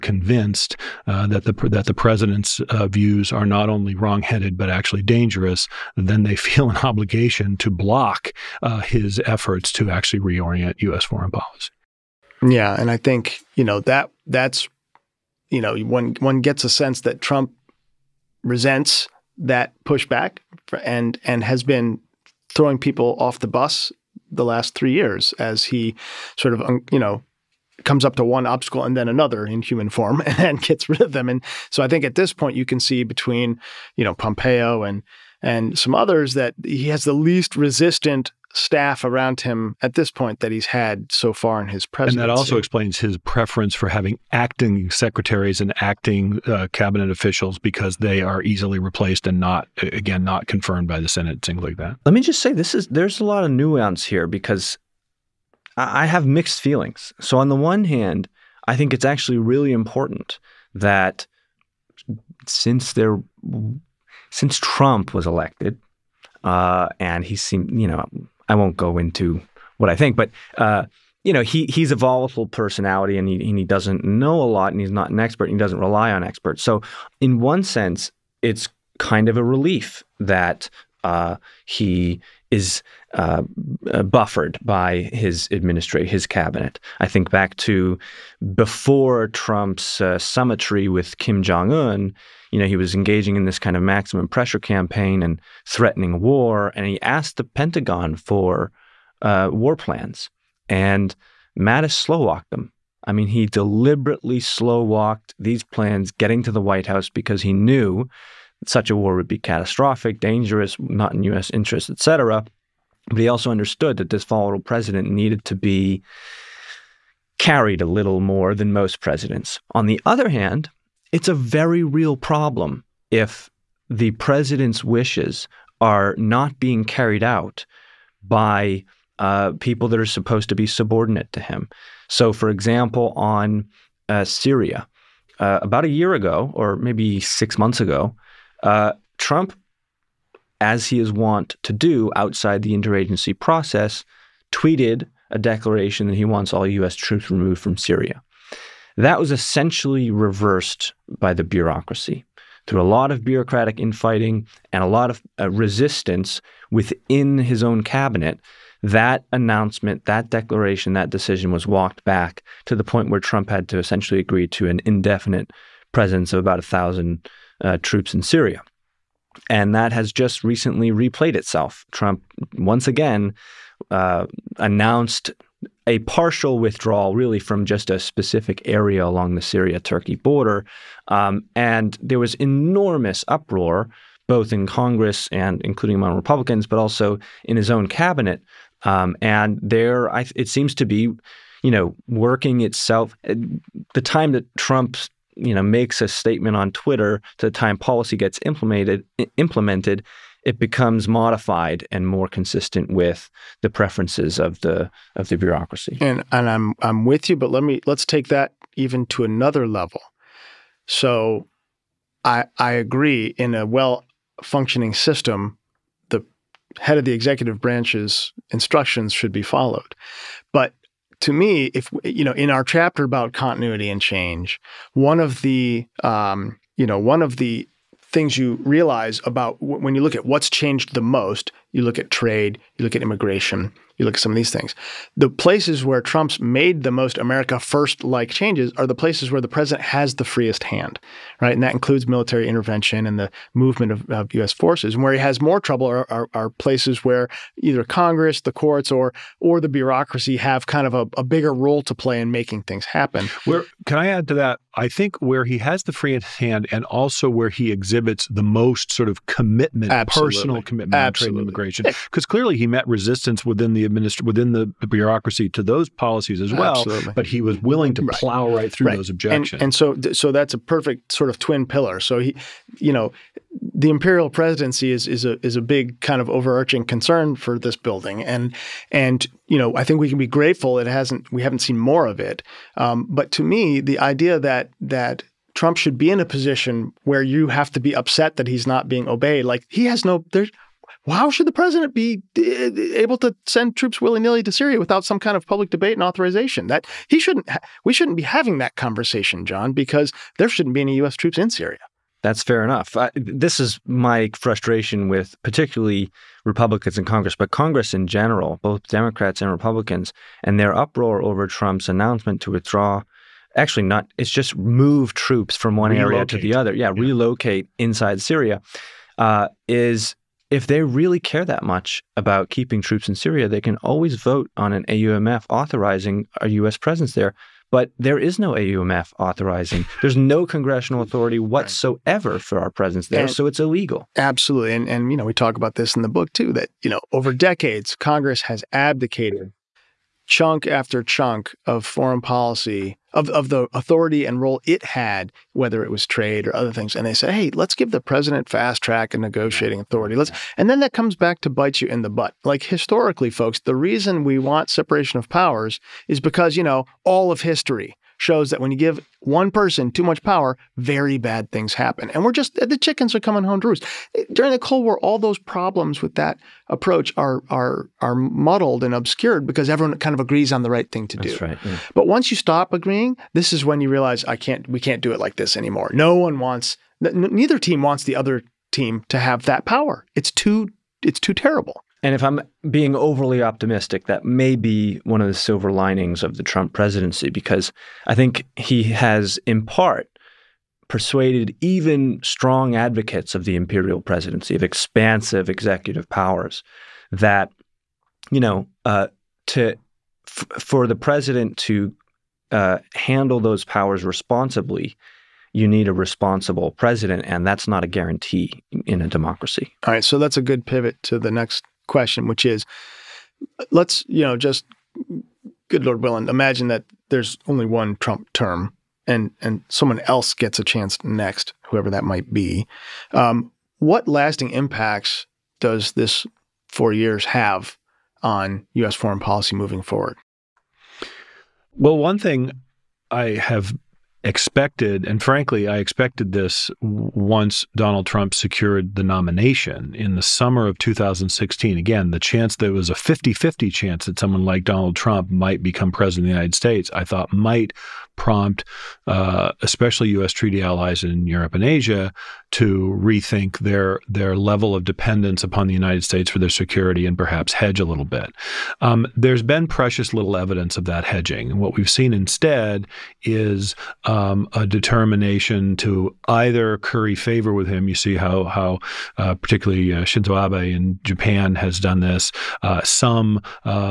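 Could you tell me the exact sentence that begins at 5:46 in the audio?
And they said, hey, let's give the president fast track and negotiating authority.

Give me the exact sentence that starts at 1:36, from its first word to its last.
And he asked the Pentagon for uh, war plans.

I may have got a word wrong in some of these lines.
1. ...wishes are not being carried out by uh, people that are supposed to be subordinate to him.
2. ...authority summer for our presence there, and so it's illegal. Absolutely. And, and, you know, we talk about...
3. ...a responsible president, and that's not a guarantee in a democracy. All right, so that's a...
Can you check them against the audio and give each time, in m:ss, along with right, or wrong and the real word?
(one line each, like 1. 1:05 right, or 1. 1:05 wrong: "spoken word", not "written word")
1. 2:04 right
2. 5:30 wrong: "whatsoever", not "summer"
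3. 6:45 right.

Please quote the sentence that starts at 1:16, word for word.
So, in one sense, it's kind of a relief that uh, he is uh, uh buffered by his administration, his cabinet.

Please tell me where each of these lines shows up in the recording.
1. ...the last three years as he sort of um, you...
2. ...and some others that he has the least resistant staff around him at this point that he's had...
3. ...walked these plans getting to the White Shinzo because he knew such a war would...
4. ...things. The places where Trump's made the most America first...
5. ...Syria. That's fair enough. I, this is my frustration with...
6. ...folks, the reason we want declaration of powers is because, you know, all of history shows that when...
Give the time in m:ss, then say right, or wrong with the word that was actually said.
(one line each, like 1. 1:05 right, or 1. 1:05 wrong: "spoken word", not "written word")
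1. 0:24 right
2. 0:35 right
3. 1:44 wrong: "House", not "Shinzo"
4. 3:54 right
5. 5:01 right
6. 5:53 wrong: "separation", not "declaration".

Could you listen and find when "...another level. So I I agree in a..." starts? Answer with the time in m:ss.
3:29.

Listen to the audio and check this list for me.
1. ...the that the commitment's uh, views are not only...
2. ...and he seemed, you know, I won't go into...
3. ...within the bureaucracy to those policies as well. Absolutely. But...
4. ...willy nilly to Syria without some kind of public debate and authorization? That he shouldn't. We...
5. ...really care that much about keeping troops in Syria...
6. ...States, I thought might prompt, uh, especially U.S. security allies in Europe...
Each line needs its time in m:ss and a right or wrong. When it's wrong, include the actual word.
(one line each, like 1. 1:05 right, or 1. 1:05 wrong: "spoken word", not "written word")
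1. 0:01 wrong: "president", not "commitment"
2. 1:06 right
3. 4:24 right
4. 4:53 right
5. 5:20 right
6. 7:26 wrong: "treaty", not "security".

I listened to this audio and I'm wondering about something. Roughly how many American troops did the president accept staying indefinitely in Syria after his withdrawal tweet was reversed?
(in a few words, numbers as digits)
1000.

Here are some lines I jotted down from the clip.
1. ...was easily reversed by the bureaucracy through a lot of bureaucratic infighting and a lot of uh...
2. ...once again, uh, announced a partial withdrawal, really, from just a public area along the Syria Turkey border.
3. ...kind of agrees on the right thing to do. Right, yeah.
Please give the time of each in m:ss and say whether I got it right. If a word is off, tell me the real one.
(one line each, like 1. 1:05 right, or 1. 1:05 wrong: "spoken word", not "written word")
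1. 2:29 wrong: "essentially", not "easily"
2. 2:52 wrong: "specific", not "public"
3. 6:09 right.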